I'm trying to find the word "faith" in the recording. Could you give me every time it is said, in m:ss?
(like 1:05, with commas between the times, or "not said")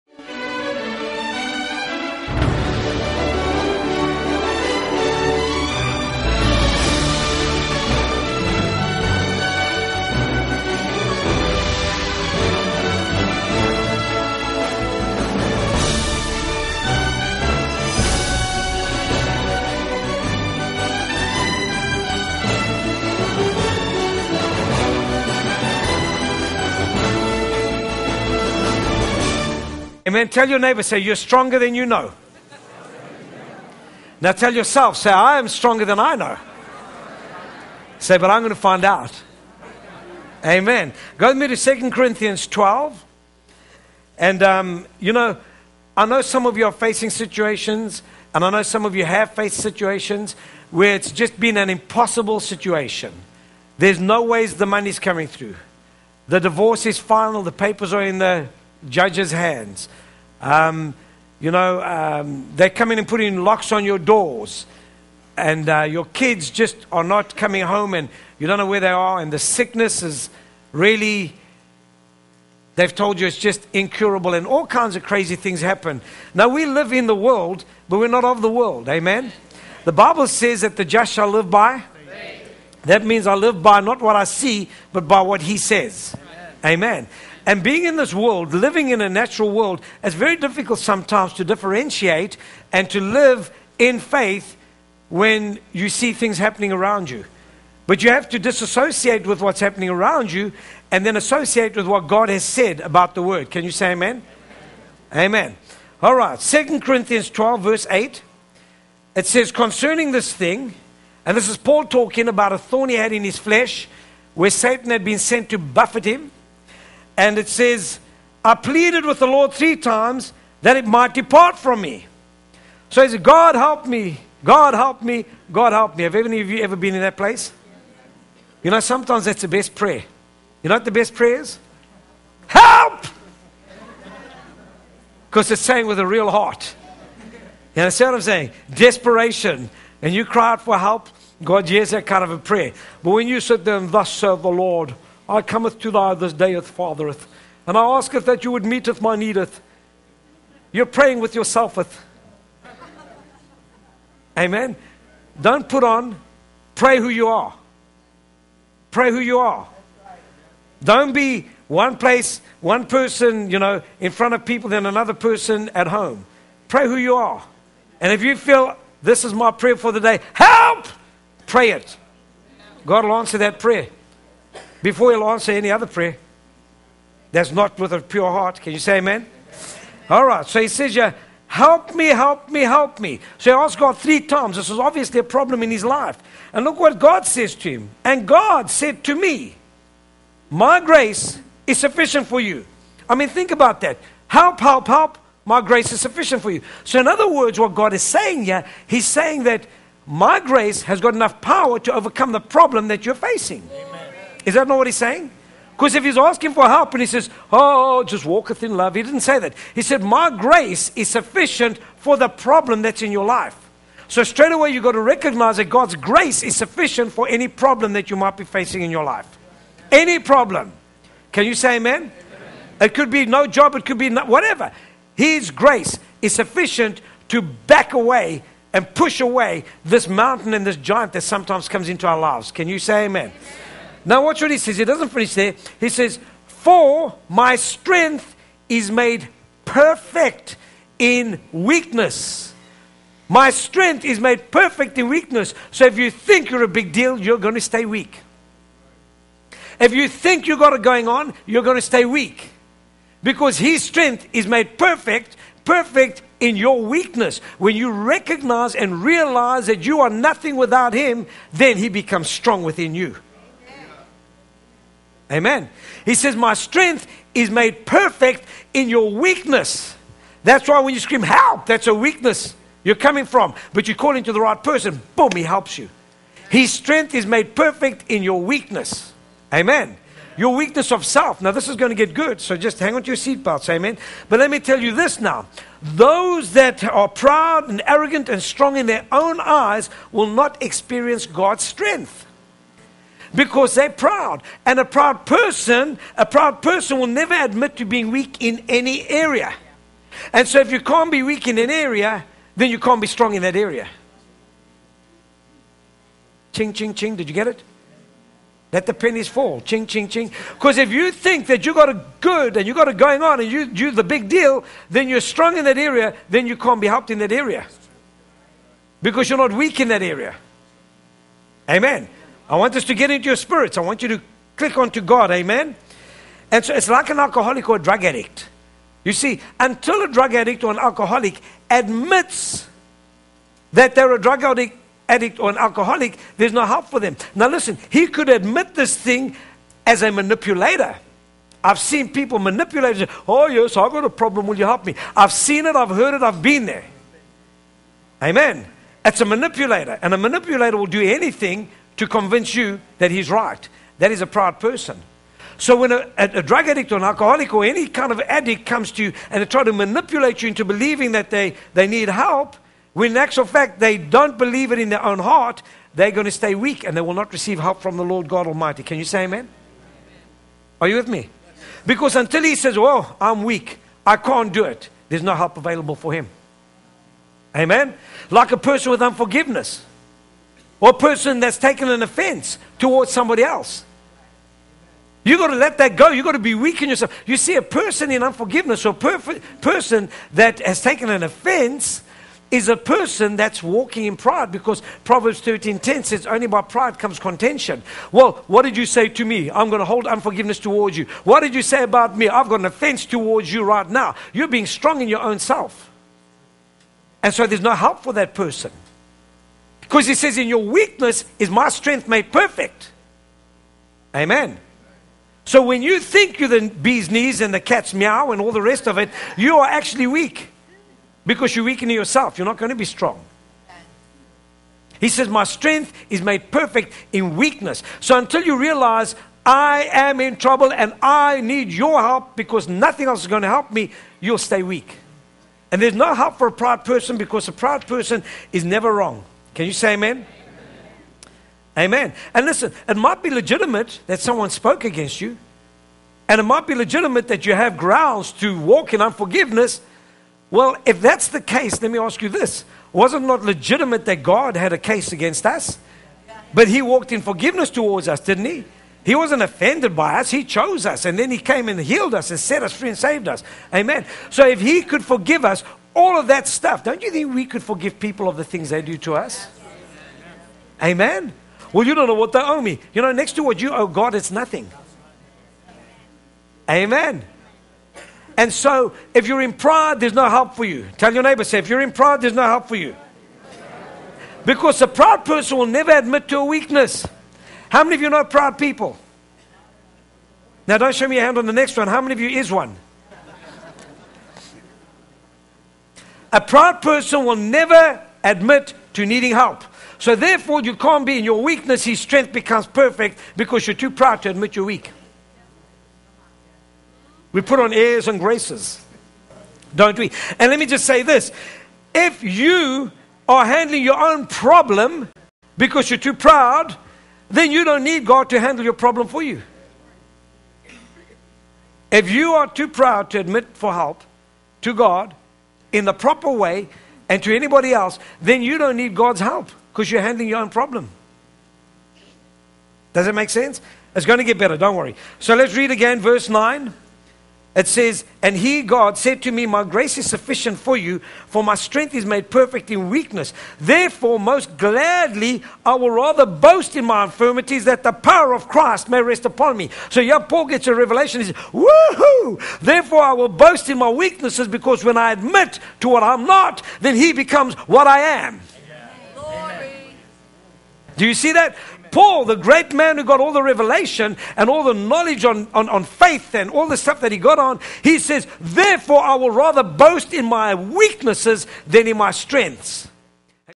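1:33, 9:25.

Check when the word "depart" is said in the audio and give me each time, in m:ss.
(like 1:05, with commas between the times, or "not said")
2:01.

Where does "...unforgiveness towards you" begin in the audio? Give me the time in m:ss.
6:40.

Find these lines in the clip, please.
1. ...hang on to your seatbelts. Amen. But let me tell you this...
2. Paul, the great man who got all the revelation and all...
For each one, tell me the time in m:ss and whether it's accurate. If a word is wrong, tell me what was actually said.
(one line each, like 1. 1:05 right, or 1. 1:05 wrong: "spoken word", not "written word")
1. 4:42 right
2. 9:21 right.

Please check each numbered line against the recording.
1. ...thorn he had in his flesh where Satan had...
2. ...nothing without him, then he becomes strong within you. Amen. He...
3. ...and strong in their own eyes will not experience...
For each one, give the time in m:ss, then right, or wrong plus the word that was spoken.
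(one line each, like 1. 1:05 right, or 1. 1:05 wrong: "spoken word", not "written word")
1. 1:52 right
2. 4:20 right
3. 4:48 right.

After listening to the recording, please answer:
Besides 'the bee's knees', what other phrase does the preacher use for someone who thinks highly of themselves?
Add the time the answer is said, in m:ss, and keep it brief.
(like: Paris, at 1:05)
the cat's meow, at 6:57.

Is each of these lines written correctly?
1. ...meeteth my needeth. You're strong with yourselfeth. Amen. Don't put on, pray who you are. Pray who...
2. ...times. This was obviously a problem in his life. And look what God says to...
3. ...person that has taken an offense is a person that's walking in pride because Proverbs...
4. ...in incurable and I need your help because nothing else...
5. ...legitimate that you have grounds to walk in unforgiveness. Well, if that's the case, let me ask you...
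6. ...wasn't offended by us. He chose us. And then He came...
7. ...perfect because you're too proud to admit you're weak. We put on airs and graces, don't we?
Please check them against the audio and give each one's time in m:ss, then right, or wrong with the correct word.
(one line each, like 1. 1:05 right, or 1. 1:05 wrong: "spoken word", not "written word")
1. 2:28 wrong: "praying", not "strong"
2. 3:04 right
3. 6:29 right
4. 7:10 wrong: "trouble", not "incurable"
5. 7:26 right
6. 7:39 right
7. 8:22 right.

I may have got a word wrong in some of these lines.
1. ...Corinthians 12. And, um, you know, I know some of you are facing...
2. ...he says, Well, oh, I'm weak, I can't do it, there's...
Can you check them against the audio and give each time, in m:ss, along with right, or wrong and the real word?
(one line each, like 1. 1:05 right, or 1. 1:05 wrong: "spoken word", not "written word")
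1. 0:41 right
2. 6:12 right.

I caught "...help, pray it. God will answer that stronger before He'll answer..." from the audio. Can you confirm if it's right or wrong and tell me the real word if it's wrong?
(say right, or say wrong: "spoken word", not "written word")
wrong: "prayer", not "stronger".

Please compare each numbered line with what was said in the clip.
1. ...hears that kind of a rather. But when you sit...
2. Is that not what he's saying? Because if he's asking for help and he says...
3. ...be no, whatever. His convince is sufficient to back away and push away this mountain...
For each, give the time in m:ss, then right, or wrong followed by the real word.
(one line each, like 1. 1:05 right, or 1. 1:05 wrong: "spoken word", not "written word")
1. 2:21 wrong: "prayer", not "rather"
2. 3:24 right
3. 3:43 wrong: "grace", not "convince".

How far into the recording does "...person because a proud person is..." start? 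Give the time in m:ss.
7:16.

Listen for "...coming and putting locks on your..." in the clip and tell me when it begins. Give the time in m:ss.
1:02.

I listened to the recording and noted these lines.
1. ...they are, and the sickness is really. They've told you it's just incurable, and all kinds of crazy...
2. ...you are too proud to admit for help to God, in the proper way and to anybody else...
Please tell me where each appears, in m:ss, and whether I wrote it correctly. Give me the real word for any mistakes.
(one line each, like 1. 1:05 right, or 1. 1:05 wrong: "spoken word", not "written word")
1. 1:08 right
2. 8:42 right.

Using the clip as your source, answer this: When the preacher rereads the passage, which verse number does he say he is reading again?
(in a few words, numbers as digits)
9.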